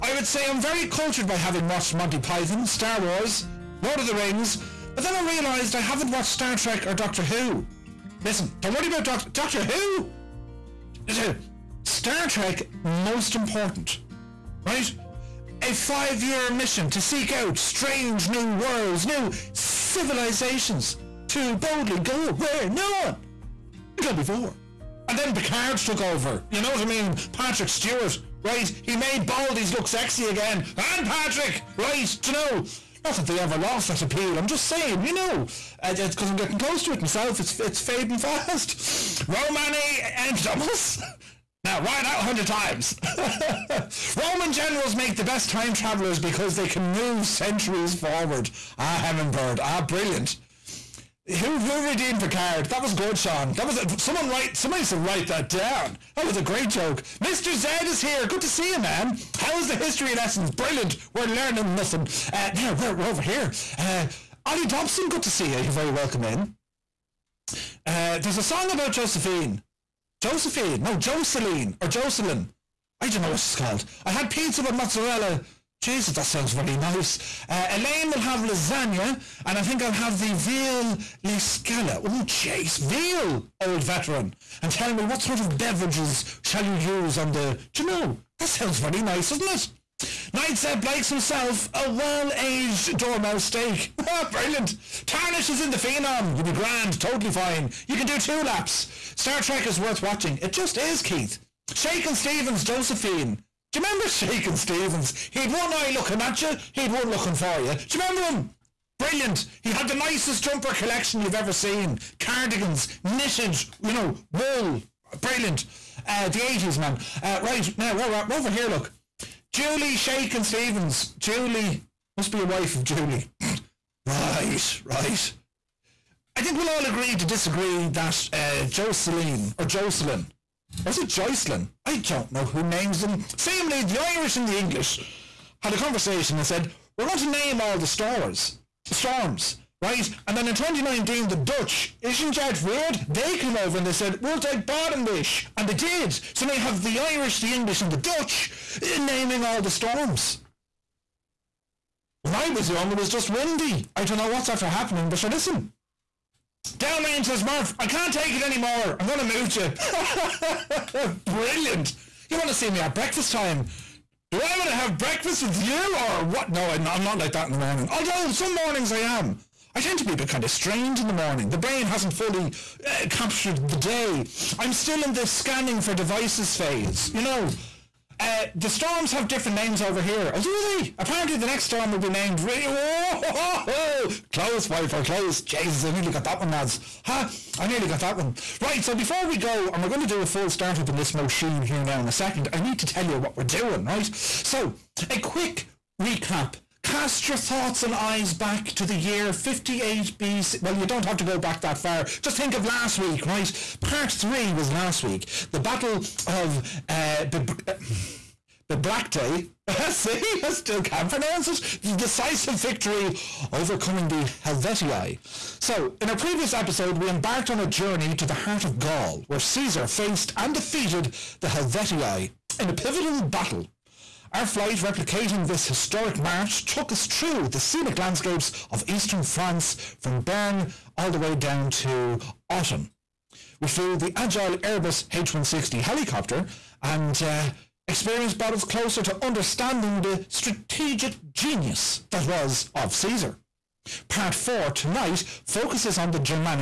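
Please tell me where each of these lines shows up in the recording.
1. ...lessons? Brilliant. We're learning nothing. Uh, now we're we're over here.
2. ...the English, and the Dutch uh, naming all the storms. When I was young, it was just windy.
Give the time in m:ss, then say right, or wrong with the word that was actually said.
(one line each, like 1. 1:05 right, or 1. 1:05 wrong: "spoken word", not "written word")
1. 1:00 right
2. 2:27 right.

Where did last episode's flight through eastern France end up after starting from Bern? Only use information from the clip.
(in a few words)
Autun.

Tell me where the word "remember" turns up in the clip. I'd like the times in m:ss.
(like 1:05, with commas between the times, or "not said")
1:43, 1:47.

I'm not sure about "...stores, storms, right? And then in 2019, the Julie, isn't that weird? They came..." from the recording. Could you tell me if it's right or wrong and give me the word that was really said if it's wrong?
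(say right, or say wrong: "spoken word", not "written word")
wrong: "Dutch", not "Julie".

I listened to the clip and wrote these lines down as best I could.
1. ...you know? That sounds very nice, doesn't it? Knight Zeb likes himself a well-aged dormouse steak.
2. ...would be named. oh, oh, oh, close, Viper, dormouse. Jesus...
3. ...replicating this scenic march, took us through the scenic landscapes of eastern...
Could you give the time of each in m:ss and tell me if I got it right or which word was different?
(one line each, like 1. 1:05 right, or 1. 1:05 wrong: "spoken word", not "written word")
1. 1:27 right
2. 3:01 wrong: "close", not "dormouse"
3. 3:44 wrong: "historic", not "scenic".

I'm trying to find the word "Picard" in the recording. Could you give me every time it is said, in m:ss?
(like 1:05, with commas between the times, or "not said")
0:25, 0:52.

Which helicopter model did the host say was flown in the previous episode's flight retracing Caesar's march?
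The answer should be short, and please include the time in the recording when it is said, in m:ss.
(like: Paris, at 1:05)
Airbus H160, at 3:54.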